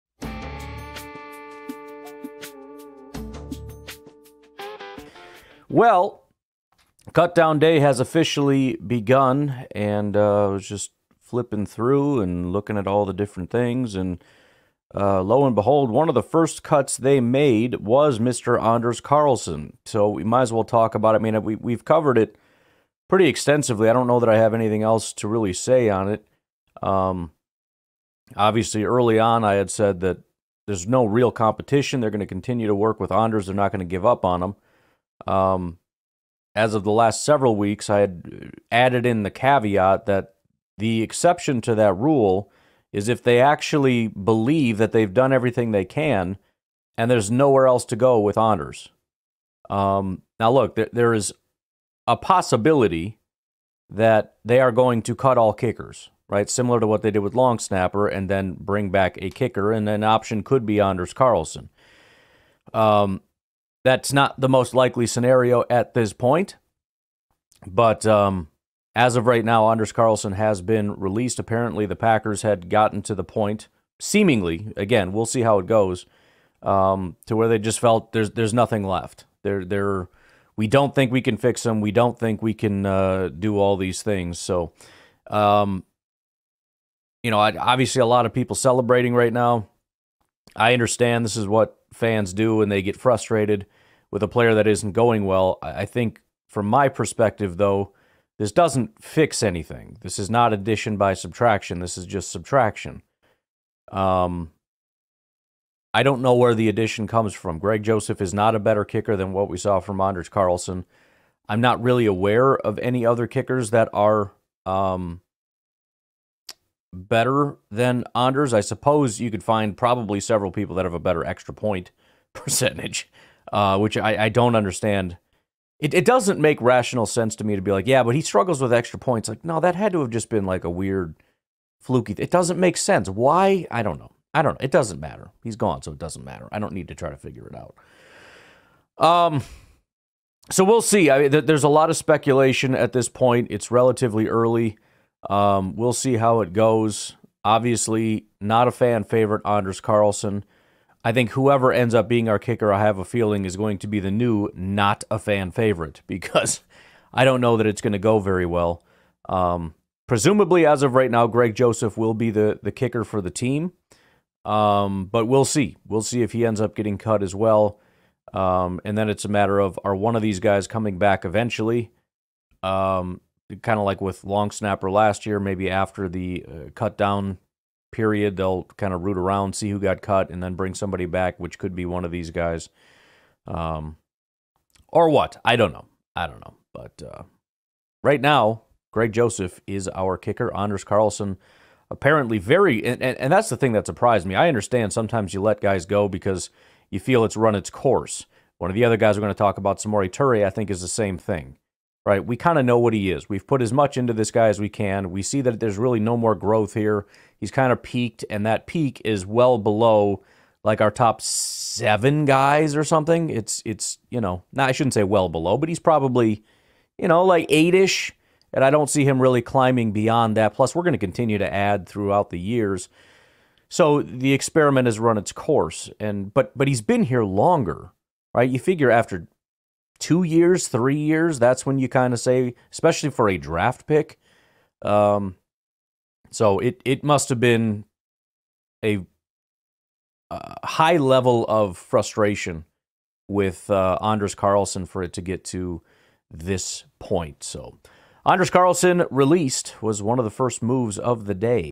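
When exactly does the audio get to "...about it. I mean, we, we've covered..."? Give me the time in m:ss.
0:20.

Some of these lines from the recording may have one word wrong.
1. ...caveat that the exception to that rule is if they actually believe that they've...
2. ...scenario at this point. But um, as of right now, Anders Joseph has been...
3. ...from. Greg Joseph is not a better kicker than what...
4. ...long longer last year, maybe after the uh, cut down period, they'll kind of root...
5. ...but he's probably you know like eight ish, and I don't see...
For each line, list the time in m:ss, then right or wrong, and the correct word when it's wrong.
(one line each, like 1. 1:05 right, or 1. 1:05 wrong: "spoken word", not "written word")
1. 0:39 right
2. 1:05 wrong: "Carlson", not "Joseph"
3. 1:47 right
4. 2:54 wrong: "snapper", not "longer"
5. 3:35 right.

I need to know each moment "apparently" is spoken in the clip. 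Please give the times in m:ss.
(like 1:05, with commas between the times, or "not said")
1:11, 3:11.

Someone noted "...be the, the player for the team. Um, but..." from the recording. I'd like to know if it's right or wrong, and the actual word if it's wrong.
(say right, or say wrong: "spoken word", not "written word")
wrong: "kicker", not "player".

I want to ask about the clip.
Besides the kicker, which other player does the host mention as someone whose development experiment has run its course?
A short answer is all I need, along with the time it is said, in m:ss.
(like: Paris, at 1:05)
Samori Toure, at 3:19.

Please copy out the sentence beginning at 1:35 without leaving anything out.
I think, from my perspective, though, this doesn't fix anything.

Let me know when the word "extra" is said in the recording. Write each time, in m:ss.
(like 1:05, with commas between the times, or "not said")
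2:01, 2:08.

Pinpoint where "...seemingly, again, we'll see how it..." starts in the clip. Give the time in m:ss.
1:13.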